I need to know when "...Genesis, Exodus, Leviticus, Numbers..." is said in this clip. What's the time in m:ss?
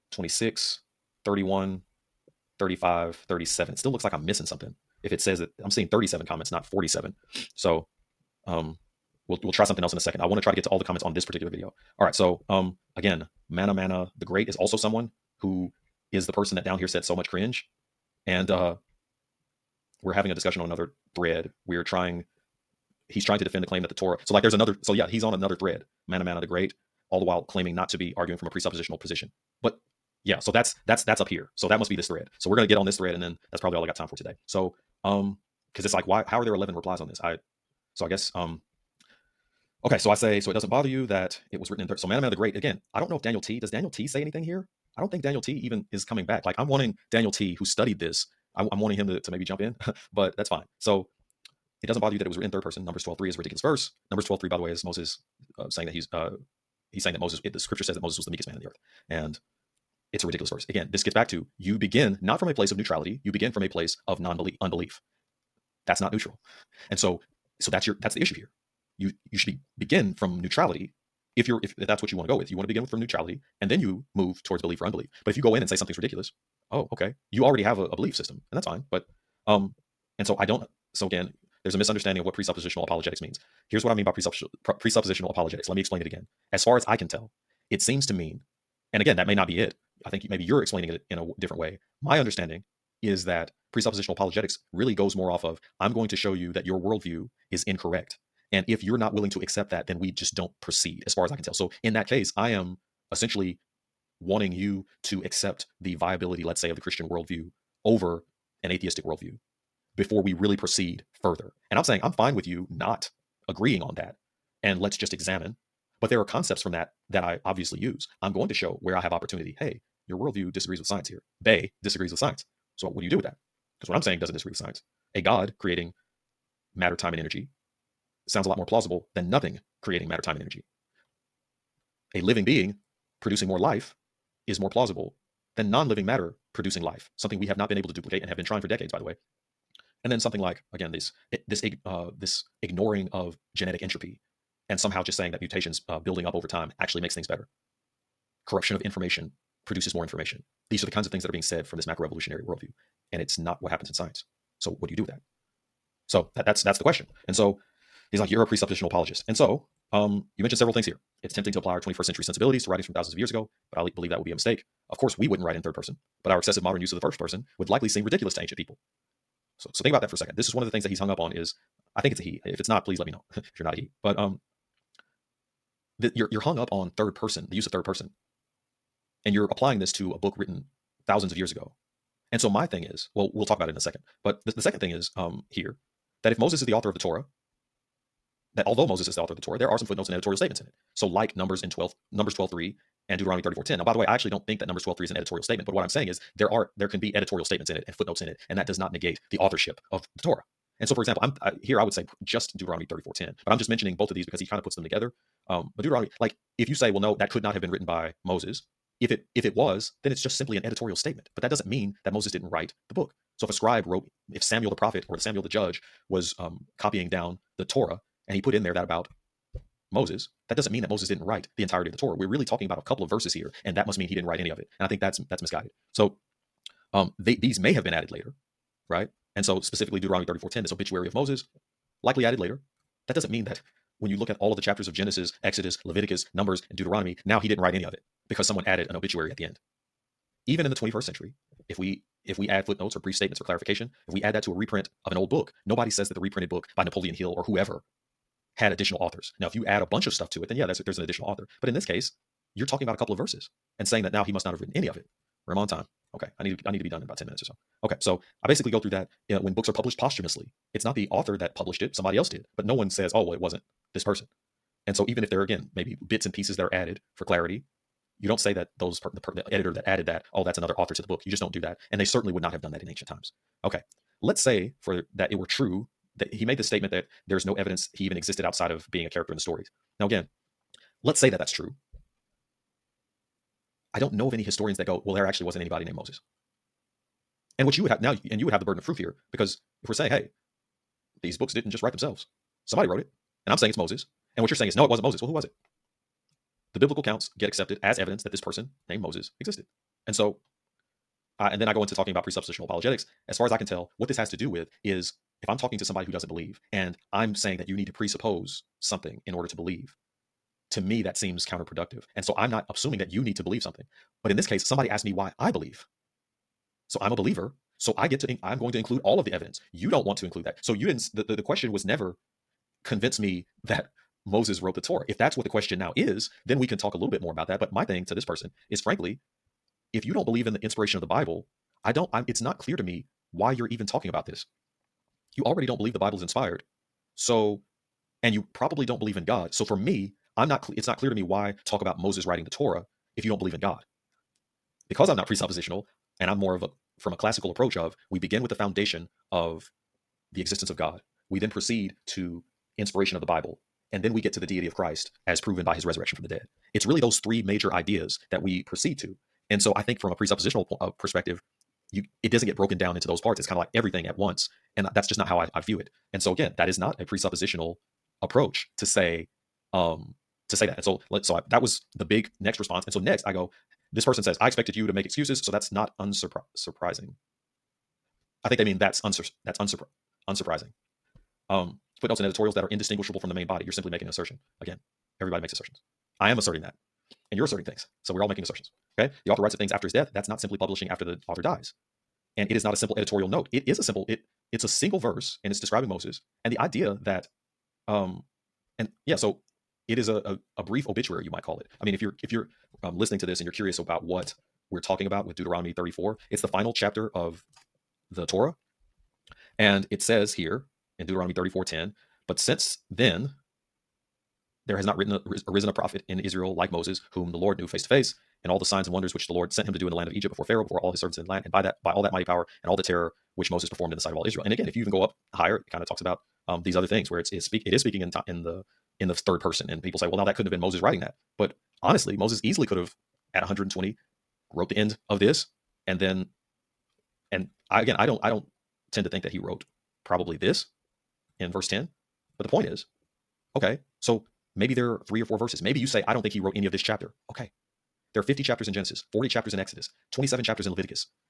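3:54.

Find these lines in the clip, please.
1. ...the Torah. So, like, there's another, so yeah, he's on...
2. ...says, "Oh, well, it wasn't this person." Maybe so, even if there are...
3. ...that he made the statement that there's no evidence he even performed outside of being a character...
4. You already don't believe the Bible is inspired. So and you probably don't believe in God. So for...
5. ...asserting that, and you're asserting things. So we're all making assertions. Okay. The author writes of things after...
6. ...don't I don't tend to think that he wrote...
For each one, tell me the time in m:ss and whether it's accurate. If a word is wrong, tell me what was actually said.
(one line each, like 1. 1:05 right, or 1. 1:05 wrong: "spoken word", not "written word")
1. 0:23 right
2. 4:22 wrong: "And", not "Maybe"
3. 4:36 wrong: "existed", not "performed"
4. 5:35 right
5. 6:26 right
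6. 7:18 right.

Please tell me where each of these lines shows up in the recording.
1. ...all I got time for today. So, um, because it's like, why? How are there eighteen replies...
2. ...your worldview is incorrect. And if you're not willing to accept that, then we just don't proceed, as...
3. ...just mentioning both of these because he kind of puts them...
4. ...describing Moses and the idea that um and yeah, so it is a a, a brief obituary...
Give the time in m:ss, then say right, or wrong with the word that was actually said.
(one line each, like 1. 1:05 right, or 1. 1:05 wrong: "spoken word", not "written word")
1. 0:33 wrong: "eleven", not "eighteen"
2. 1:36 right
3. 3:23 right
4. 6:35 right.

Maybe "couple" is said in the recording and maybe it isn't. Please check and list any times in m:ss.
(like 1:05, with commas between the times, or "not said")
3:42, 4:12.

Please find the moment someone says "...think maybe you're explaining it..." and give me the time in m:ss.
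1:30.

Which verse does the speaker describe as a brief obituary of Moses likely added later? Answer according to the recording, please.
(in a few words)
Deuteronomy 34:10.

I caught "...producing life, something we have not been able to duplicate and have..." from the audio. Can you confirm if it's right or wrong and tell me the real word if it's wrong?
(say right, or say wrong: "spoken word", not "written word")
right.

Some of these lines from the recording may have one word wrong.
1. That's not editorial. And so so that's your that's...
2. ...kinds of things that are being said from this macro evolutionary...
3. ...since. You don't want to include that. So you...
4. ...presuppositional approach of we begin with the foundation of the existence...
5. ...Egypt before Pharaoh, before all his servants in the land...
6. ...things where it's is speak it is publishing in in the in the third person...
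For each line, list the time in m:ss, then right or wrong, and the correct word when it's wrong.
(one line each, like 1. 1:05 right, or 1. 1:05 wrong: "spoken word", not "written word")
1. 1:05 wrong: "neutral", not "editorial"
2. 2:30 right
3. 5:19 wrong: "evidence", not "since"
4. 5:47 wrong: "classical", not "presuppositional"
5. 7:00 right
6. 7:06 wrong: "speaking", not "publishing".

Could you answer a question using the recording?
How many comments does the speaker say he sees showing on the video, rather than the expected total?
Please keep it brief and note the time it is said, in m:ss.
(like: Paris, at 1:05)
37, at 0:05.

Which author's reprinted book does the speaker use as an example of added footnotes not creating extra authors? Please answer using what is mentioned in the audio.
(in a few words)
Napoleon Hill.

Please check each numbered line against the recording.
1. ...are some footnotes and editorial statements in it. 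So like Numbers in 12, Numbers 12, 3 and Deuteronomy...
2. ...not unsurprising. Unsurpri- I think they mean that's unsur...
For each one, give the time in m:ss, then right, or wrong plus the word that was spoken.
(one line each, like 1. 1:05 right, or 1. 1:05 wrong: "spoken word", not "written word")
1. 3:09 right
2. 6:15 right.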